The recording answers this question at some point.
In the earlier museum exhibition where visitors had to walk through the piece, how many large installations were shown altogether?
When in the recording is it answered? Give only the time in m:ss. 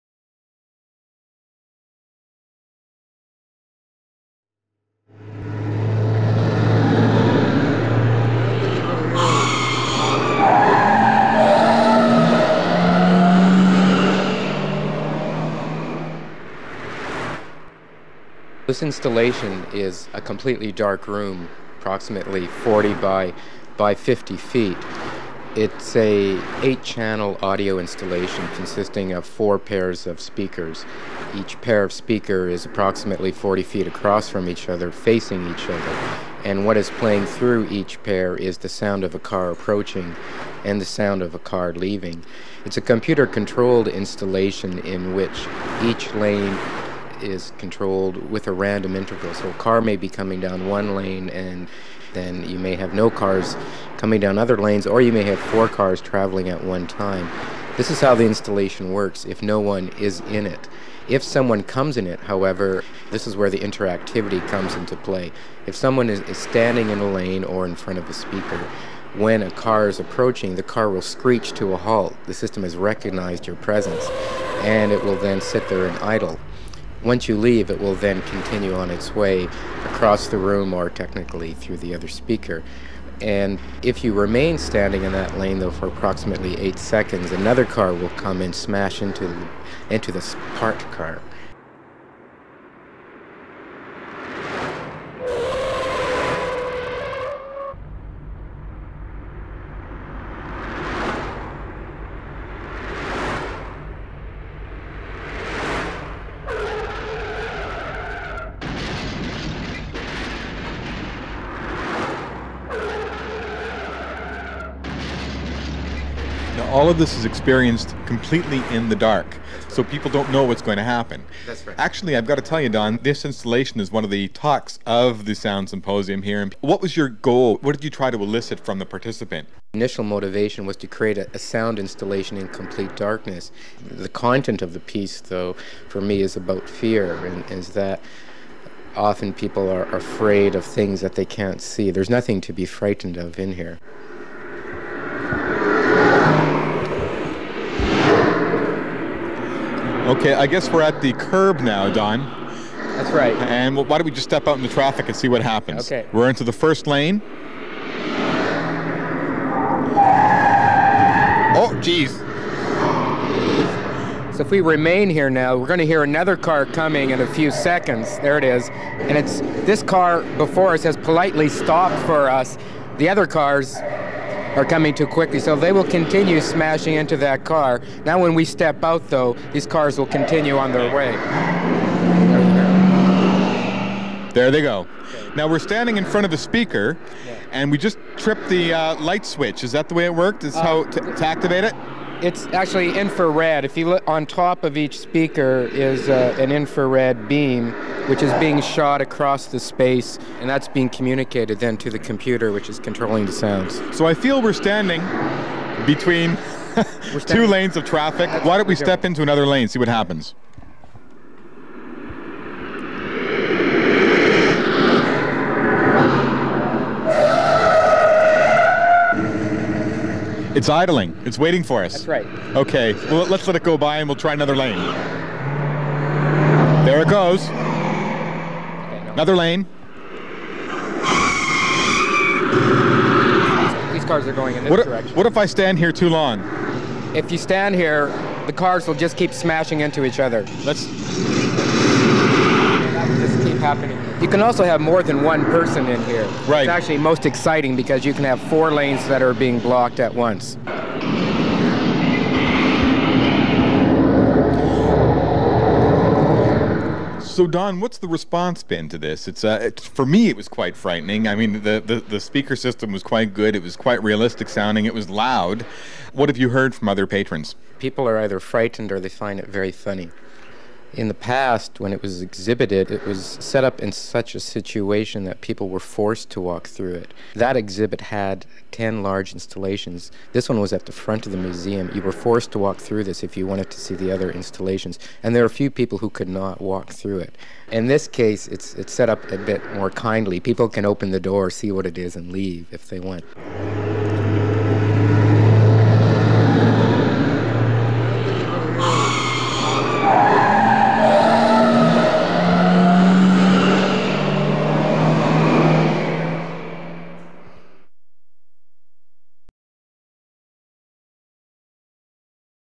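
4:38.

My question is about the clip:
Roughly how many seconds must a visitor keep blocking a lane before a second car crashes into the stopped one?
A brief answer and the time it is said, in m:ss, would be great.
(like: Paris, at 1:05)
8, at 1:26.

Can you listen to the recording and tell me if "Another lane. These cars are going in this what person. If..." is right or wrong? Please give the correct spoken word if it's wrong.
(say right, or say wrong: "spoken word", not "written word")
wrong: "direction", not "person".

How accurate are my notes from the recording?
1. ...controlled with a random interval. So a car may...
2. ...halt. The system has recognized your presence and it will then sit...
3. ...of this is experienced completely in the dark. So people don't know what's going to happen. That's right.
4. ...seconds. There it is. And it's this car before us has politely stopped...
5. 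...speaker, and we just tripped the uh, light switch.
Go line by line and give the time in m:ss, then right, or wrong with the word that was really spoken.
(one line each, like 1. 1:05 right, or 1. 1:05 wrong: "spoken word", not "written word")
1. 0:47 right
2. 1:11 right
3. 1:56 right
4. 2:47 right
5. 3:06 right.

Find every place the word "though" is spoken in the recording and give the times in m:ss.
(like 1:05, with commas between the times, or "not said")
1:25, 2:15, 2:59.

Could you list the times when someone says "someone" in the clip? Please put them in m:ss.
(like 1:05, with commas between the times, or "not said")
1:01, 1:05.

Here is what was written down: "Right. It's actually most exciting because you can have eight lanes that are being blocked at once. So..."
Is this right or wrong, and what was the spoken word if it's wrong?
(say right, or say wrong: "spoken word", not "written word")
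wrong: "four", not "eight".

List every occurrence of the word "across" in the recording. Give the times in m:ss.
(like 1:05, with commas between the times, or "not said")
0:33, 1:19, 3:19.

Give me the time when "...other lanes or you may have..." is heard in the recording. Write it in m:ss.
0:54.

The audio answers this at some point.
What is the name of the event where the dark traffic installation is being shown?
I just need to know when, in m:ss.
2:05.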